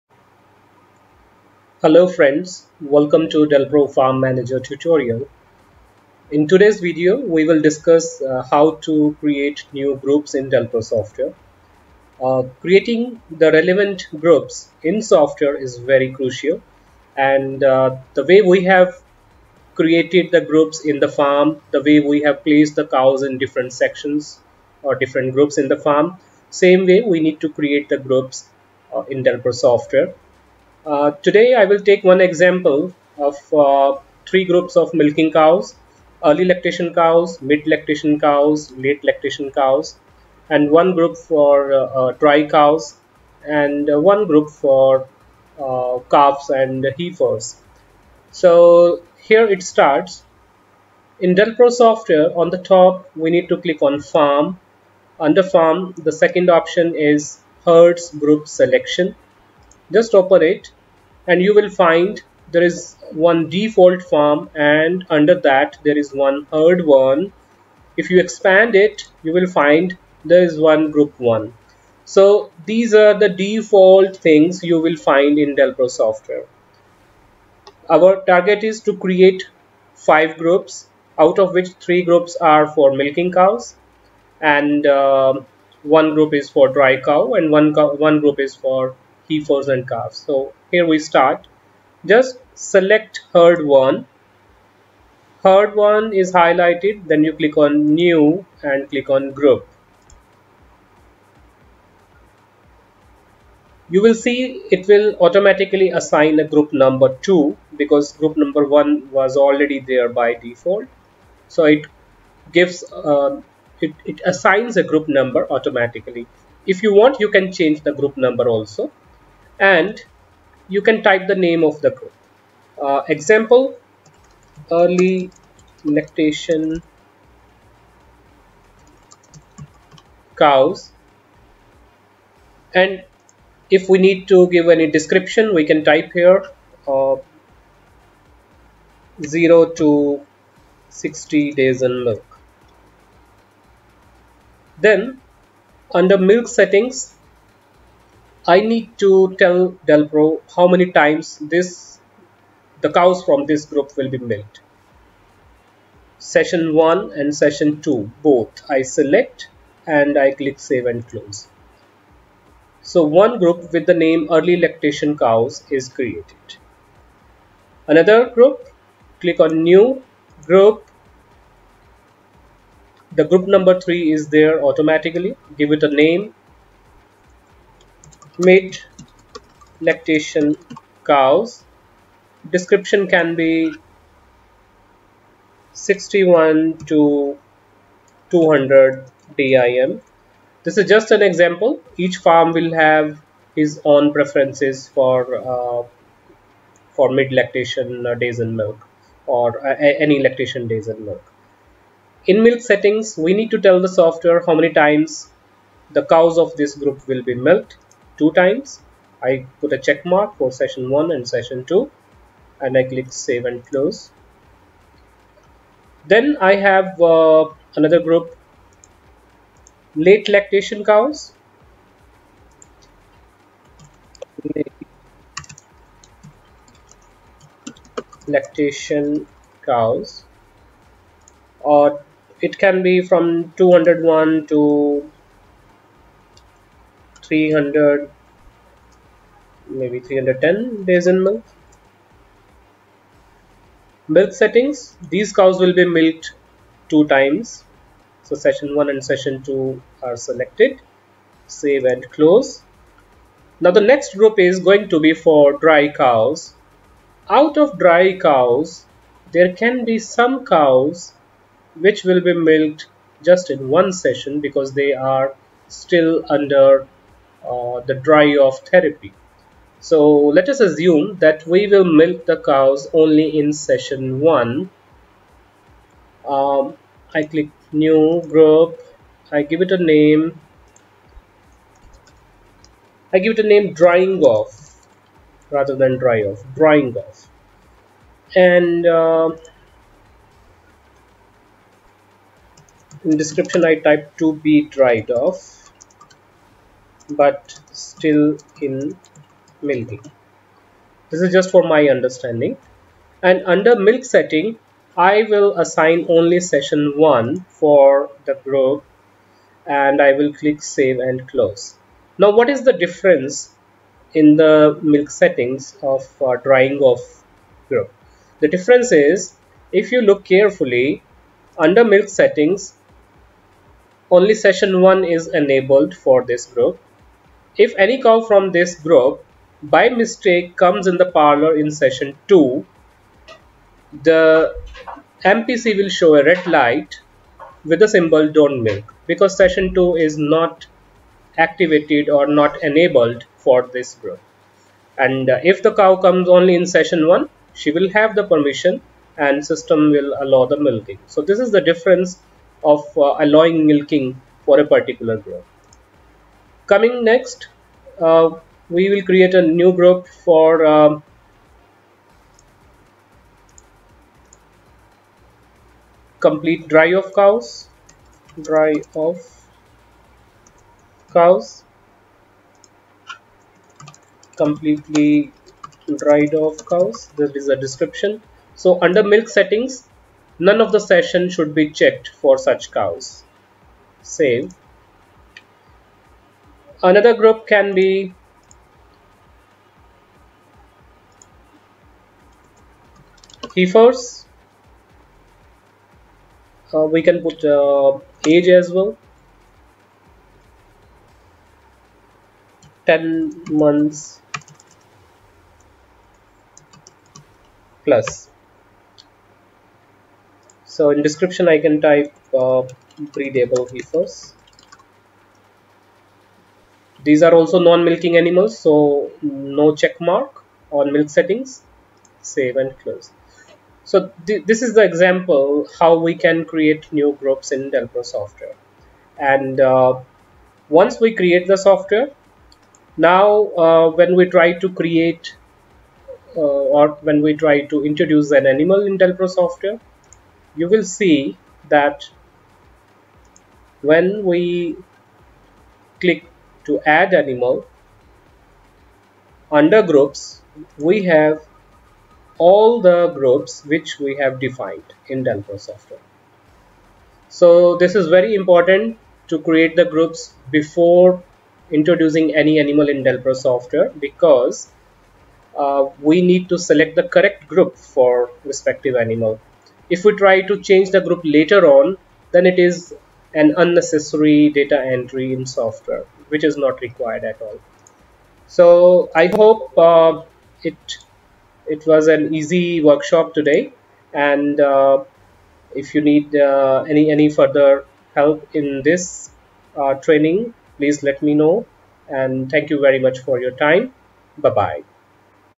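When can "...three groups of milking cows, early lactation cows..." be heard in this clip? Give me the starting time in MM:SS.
00:34.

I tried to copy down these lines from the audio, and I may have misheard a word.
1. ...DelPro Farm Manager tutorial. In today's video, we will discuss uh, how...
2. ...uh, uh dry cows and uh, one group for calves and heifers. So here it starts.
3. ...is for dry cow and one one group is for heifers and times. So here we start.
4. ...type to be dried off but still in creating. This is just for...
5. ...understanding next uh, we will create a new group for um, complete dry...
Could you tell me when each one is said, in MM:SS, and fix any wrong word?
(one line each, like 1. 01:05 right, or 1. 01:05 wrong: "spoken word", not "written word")
1. 00:03 right
2. 00:41 right
3. 01:26 wrong: "calves", not "times"
4. 04:53 wrong: "milking", not "creating"
5. 05:56 wrong: "coming", not "understanding".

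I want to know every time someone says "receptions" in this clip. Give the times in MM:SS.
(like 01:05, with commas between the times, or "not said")
not said.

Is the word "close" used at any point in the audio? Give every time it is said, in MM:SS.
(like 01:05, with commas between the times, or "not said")
02:41, 03:33, 04:12, 05:11, 07:02.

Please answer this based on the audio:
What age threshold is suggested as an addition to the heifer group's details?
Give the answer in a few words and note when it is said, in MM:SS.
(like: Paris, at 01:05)
10 months plus, at 06:42.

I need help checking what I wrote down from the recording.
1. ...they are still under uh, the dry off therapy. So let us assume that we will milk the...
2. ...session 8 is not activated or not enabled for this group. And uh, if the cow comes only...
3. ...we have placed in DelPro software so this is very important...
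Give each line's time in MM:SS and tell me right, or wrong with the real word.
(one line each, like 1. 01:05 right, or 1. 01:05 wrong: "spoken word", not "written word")
1. 04:24 right
2. 05:39 wrong: "2", not "8"
3. 07:33 wrong: "defined", not "placed".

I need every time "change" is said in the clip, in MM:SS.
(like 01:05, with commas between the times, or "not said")
01:57, 07:50.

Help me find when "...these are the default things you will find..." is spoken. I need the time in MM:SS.
01:12.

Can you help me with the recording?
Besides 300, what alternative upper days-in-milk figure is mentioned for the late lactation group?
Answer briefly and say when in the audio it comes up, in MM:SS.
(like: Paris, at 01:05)
310, at 04:00.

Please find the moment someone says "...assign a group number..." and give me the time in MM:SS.
01:45.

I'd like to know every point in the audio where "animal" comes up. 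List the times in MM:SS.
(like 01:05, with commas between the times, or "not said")
06:58, 07:18, 07:27, 07:42, 07:48.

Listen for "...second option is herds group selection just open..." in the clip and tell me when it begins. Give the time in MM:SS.
00:56.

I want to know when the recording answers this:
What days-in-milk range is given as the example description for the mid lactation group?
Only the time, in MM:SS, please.
03:05.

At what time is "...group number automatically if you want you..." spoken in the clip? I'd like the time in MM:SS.
01:54.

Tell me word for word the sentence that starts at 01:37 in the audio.
Then you click on new and click on group.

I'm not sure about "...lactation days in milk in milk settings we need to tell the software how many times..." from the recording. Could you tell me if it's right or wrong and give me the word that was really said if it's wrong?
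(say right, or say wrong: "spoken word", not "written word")
right.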